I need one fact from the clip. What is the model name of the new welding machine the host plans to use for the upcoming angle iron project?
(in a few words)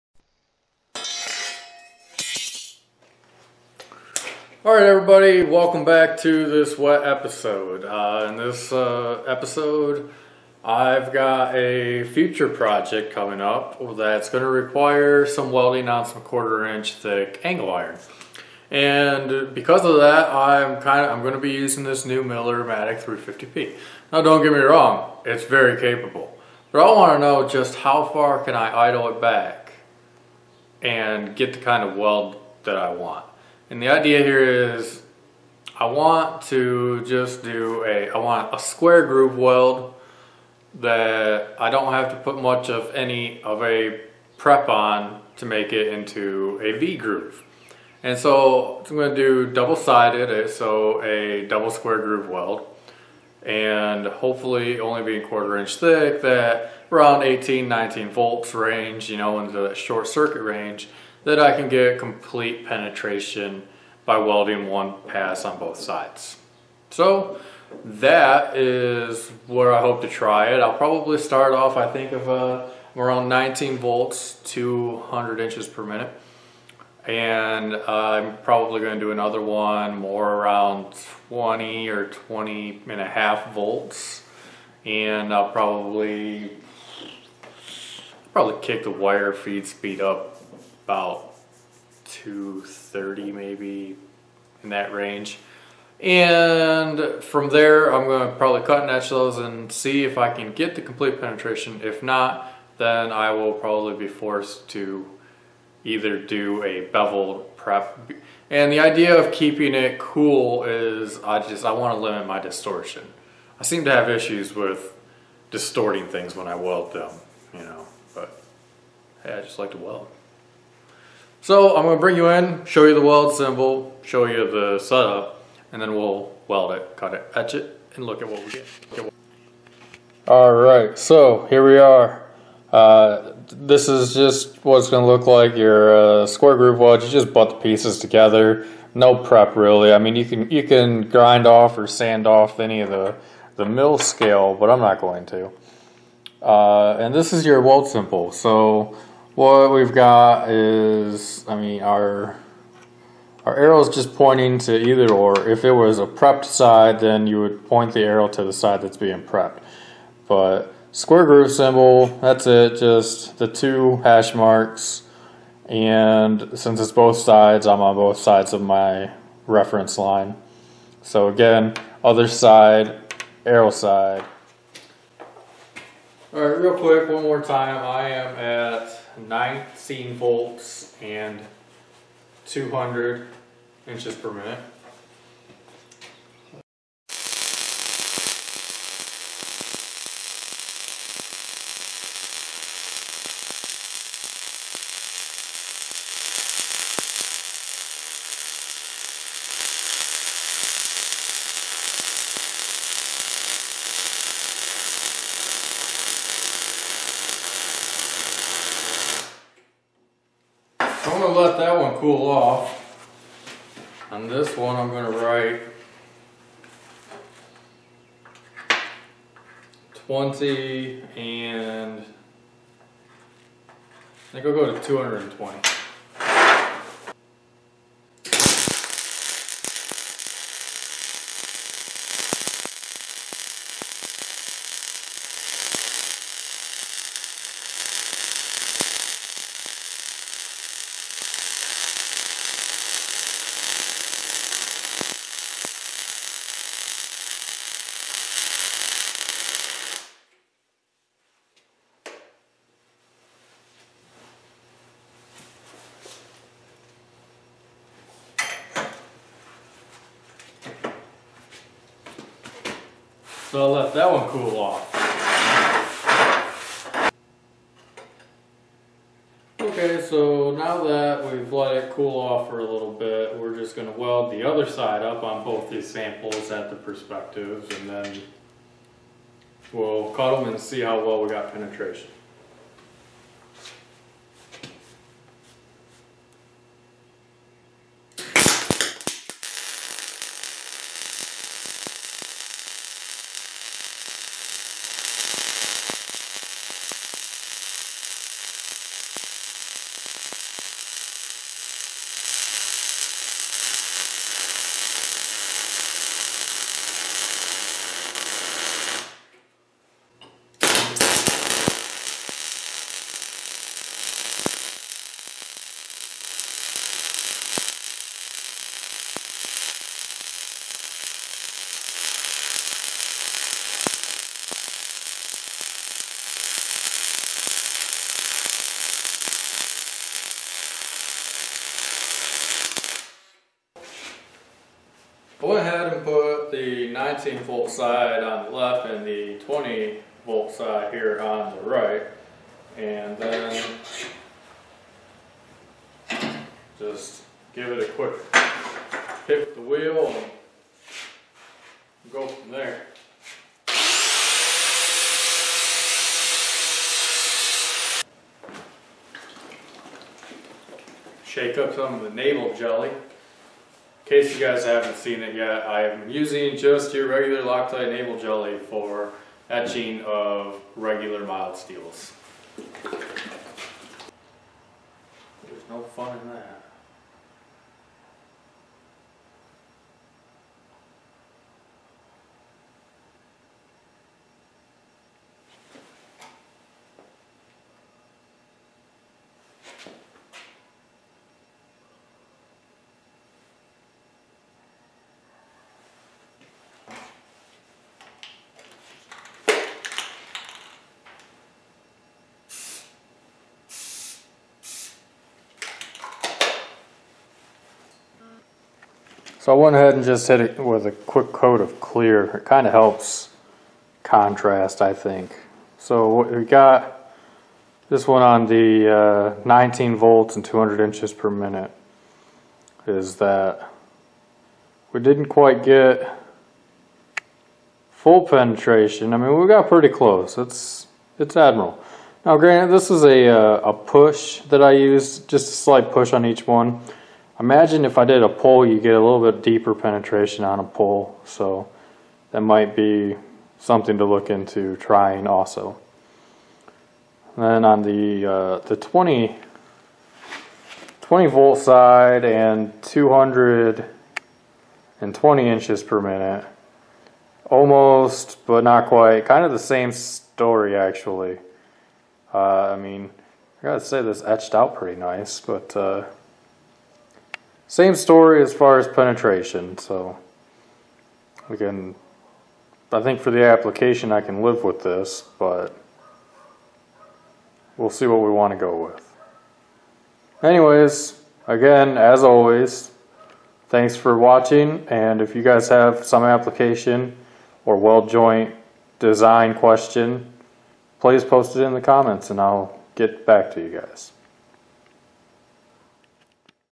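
Miller Matic 350P.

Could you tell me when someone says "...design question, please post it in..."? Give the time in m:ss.
8:08.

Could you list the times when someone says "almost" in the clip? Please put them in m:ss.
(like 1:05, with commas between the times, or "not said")
7:37.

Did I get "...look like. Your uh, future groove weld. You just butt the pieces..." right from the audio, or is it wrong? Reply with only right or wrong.
wrong.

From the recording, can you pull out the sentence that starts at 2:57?
I am at 19 volts and 200 inches per minute.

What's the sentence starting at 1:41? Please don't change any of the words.
If not, then I will probably be forced to either do a bevel prep.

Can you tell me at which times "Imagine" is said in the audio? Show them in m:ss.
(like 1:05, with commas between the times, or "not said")
7:17.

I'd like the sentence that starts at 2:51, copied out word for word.
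So again, other side, arrow side.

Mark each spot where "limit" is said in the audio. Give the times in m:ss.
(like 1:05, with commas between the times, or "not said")
1:52.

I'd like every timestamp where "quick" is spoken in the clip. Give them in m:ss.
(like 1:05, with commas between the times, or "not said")
2:56, 5:47, 6:50.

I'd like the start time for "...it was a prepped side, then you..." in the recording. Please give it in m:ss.
2:35.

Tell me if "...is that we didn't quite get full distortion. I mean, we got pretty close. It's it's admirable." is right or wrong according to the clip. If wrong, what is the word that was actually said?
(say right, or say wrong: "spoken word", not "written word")
wrong: "penetration", not "distortion".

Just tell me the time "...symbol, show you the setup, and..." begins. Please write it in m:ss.
2:03.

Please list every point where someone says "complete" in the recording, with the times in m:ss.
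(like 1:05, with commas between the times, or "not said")
1:01, 1:40.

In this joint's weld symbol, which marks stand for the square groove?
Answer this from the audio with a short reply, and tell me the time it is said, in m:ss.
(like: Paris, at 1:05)
two hash marks, at 2:43.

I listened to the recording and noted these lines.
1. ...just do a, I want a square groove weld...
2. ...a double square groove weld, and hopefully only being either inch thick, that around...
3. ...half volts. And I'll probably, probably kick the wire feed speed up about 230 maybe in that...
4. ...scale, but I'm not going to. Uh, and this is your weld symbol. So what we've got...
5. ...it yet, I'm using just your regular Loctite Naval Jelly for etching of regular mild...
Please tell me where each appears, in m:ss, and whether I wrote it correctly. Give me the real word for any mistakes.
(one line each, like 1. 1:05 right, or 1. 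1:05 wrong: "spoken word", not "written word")
1. 0:37 right
2. 0:51 wrong: "quarter", not "either"
3. 1:23 right
4. 2:23 right
5. 6:05 right.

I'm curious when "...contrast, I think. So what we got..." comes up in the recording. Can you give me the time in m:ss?
6:54.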